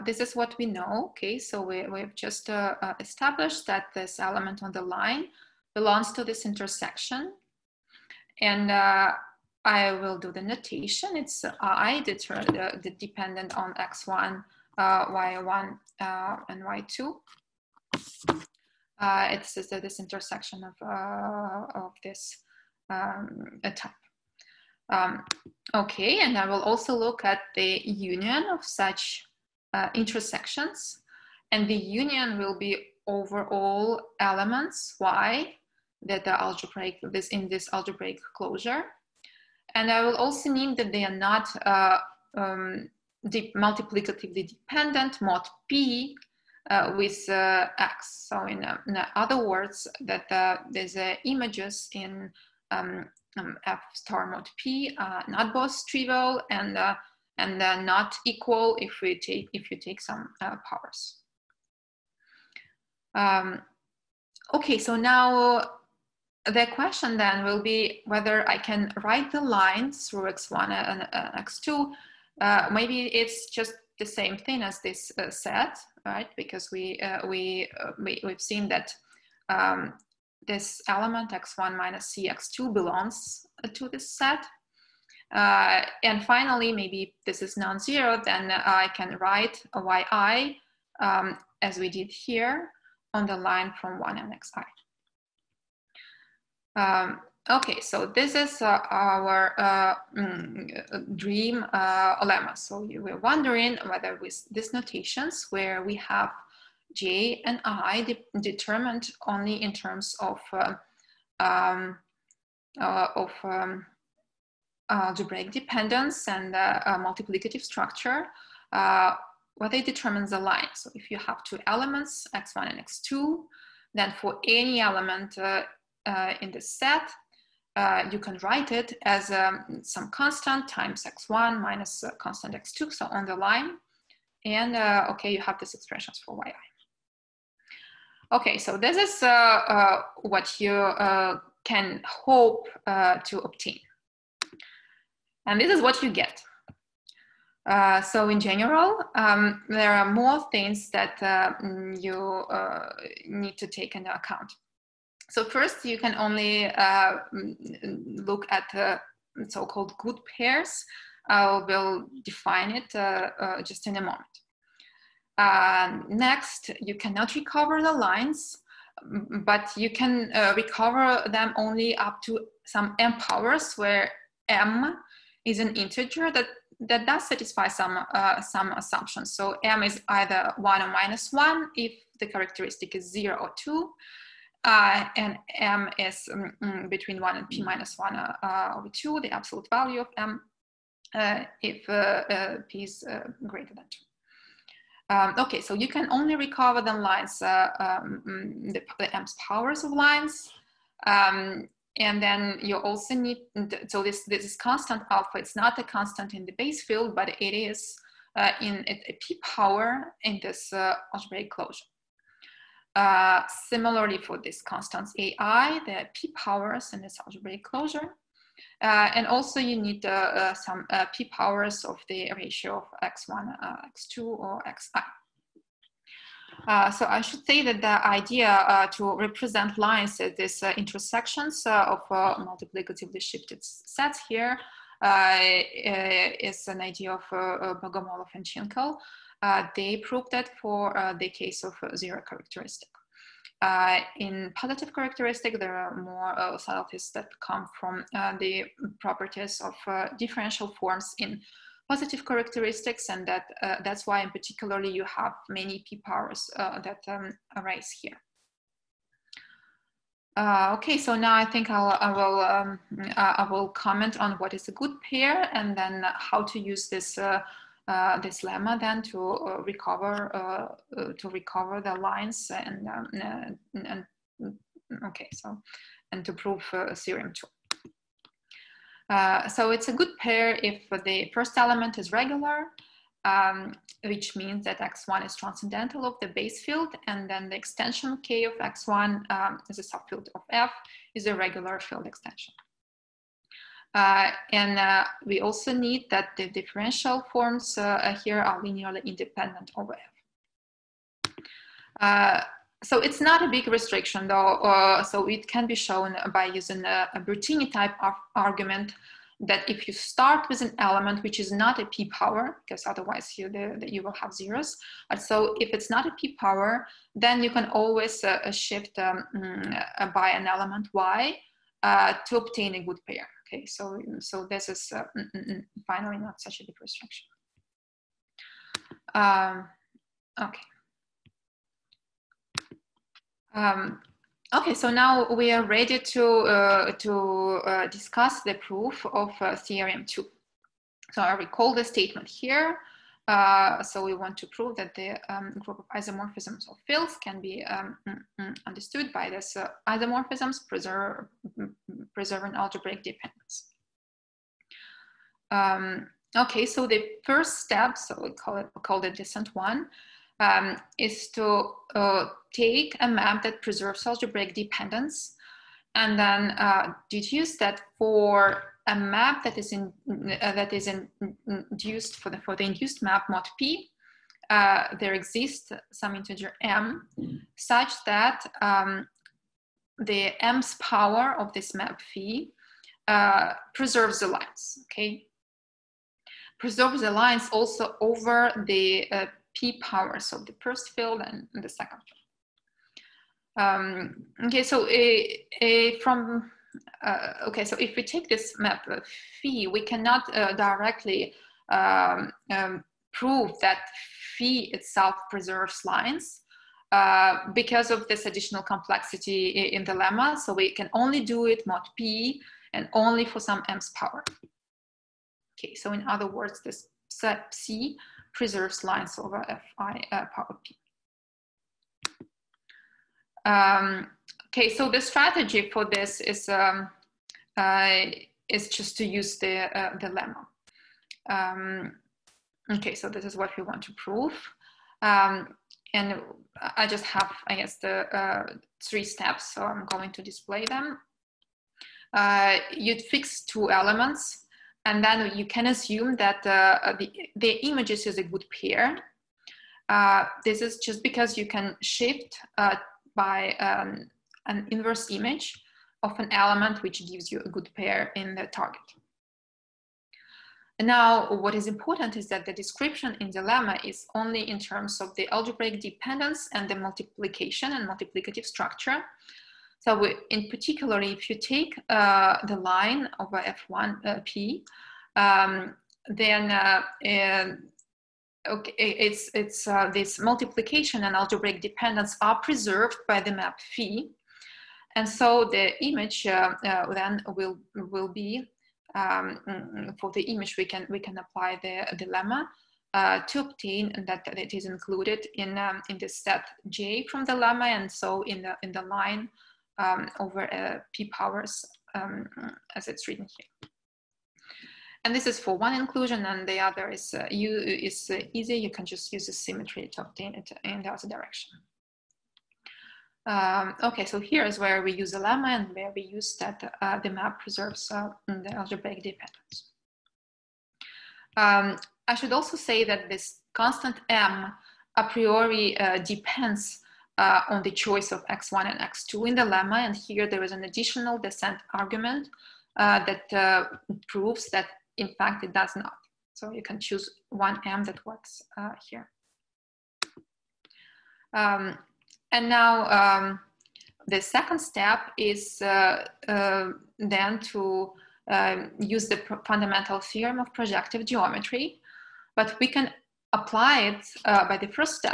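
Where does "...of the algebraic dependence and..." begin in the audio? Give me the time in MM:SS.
07:45.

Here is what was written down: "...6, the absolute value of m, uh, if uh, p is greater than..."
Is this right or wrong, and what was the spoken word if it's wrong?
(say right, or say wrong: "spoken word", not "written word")
wrong: "2", not "6".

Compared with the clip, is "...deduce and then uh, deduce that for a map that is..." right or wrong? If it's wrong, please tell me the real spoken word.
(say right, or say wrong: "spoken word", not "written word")
wrong: "dependence", not "deduce".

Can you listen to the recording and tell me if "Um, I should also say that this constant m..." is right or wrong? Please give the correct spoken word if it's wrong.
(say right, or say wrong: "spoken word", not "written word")
right.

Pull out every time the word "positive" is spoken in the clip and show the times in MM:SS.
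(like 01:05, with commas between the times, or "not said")
04:04, 04:11.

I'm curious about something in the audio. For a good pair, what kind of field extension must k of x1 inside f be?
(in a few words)
regular field extension.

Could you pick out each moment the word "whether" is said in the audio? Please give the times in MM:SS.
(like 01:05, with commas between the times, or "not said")
01:08, 01:43, 01:59.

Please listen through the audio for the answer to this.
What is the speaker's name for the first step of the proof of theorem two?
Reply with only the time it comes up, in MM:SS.
05:59.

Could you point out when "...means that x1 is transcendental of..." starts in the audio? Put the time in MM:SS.
04:44.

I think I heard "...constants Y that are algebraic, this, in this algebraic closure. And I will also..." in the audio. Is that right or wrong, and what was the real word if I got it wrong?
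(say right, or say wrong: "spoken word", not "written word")
wrong: "elements", not "constants".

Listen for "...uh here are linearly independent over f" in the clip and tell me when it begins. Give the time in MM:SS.
04:58.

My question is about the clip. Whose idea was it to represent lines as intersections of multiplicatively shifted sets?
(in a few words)
Bogomolov and Tschinkel.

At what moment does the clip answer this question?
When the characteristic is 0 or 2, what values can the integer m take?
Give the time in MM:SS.
03:00.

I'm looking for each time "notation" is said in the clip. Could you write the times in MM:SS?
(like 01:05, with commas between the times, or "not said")
00:10, 01:44.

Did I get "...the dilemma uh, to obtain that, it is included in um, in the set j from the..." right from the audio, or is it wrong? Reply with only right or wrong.
right.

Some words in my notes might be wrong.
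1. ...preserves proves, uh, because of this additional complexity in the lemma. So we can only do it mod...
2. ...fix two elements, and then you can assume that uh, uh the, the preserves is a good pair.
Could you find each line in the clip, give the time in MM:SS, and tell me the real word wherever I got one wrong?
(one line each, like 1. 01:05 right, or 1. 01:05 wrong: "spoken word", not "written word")
1. 06:45 wrong: "lines", not "proves"
2. 07:23 wrong: "images", not "preserves".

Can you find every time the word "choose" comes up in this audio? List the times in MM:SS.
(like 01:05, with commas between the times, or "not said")
08:56.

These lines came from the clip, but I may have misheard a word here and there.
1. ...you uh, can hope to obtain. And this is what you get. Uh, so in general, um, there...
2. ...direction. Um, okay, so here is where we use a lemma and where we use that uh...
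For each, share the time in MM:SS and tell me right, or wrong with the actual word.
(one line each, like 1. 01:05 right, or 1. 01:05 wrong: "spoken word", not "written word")
1. 02:20 right
2. 08:31 right.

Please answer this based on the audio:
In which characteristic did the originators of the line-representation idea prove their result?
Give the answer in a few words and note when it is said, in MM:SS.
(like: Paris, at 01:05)
zero characteristic, at 04:01.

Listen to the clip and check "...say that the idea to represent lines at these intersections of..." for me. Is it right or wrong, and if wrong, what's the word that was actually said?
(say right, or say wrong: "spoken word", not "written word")
right.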